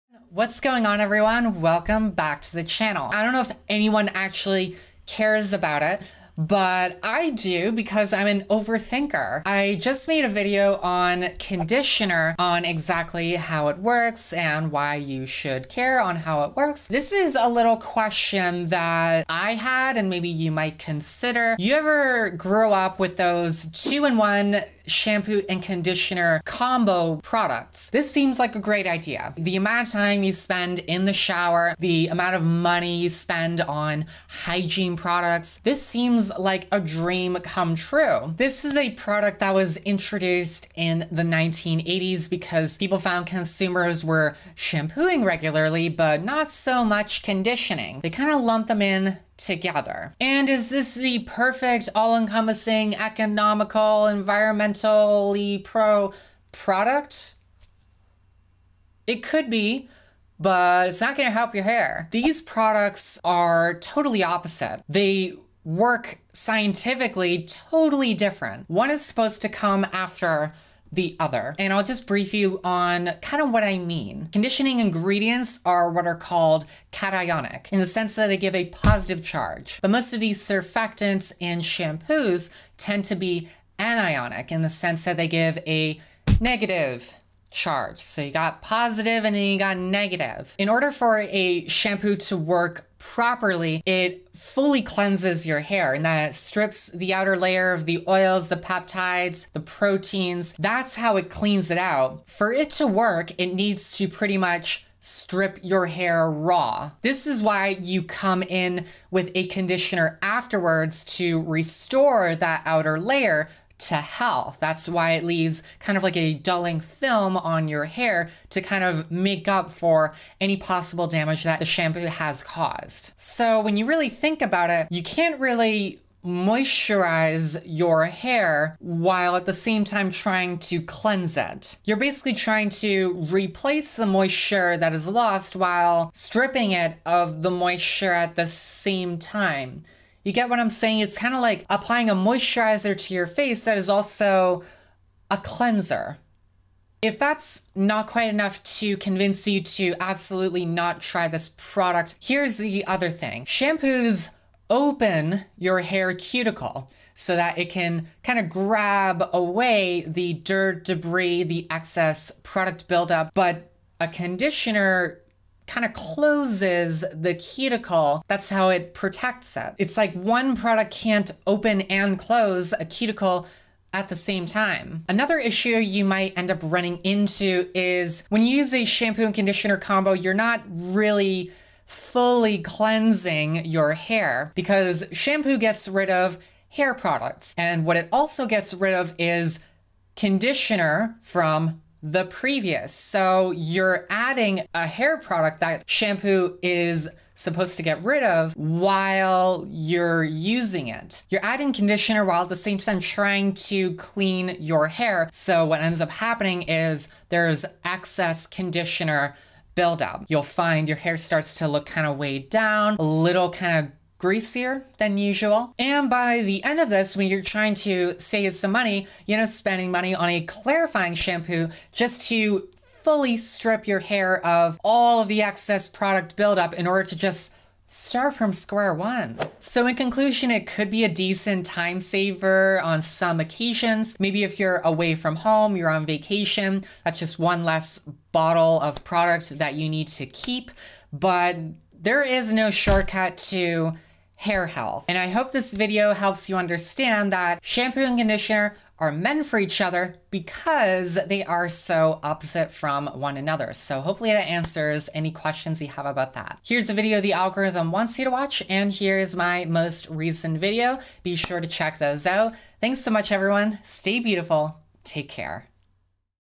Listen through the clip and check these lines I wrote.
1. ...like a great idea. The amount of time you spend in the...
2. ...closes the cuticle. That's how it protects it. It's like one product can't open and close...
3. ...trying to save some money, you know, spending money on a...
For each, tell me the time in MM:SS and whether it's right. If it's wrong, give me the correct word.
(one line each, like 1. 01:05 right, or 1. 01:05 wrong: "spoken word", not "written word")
1. 00:28 right
2. 02:45 right
3. 03:37 right.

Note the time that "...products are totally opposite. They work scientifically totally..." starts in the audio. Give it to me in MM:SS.
01:02.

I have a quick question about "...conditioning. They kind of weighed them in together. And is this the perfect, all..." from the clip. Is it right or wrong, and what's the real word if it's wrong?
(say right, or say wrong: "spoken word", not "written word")
wrong: "lumped", not "weighed".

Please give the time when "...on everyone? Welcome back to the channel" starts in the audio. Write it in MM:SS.
00:00.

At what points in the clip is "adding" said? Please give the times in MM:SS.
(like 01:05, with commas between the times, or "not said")
03:14, 03:21.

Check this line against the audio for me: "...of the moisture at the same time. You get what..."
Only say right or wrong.
right.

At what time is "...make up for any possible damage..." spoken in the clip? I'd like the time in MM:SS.
01:59.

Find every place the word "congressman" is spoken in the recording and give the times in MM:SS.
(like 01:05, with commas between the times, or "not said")
not said.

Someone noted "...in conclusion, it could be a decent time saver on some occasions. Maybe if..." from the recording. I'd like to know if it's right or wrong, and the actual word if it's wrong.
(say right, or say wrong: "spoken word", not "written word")
right.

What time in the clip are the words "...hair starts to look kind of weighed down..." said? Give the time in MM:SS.
03:30.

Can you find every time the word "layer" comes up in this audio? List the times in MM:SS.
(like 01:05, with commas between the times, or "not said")
01:37, 01:52.